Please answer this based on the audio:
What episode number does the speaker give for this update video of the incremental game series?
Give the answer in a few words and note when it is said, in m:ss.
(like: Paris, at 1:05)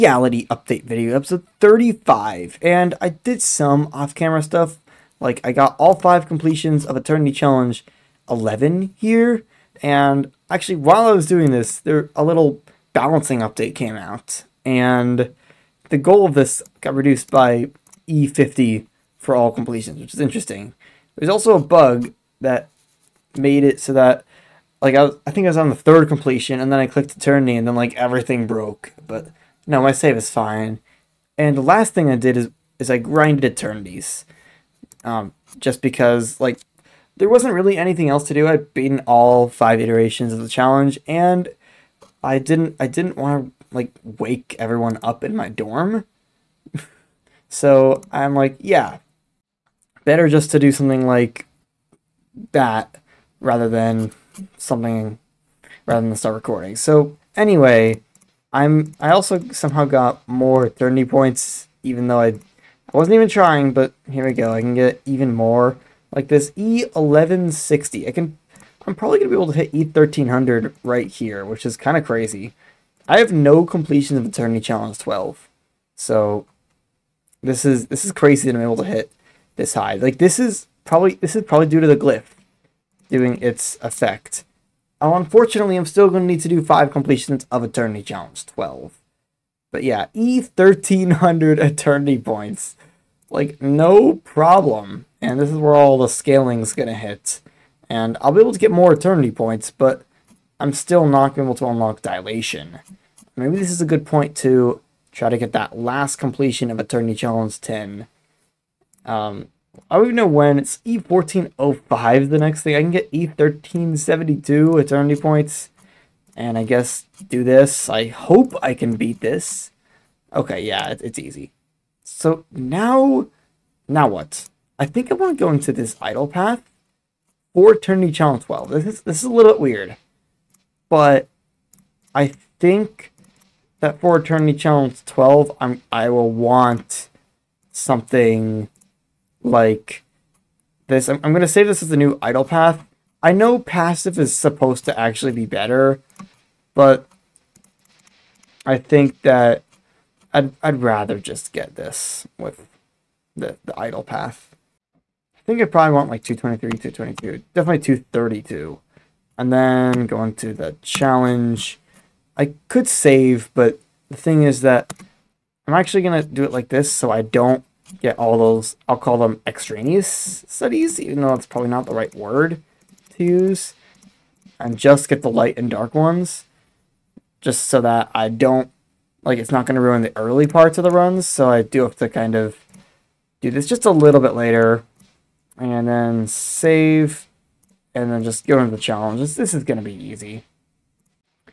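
35, at 0:01.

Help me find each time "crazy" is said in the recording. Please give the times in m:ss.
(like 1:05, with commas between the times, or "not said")
1:12, 1:18.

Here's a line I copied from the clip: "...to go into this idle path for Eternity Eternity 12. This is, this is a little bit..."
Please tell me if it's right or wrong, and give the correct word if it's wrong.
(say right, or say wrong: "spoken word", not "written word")
wrong: "Challenge", not "Eternity".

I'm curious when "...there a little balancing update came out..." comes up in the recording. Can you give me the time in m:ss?
0:11.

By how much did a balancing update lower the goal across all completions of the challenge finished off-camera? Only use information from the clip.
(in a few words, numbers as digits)
E50.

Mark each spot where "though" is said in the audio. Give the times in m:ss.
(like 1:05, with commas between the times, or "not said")
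1:02, 2:51.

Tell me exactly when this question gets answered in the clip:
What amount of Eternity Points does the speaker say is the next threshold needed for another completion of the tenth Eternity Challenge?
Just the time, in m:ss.
1:50.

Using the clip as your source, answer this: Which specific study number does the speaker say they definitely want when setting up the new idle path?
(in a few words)
232.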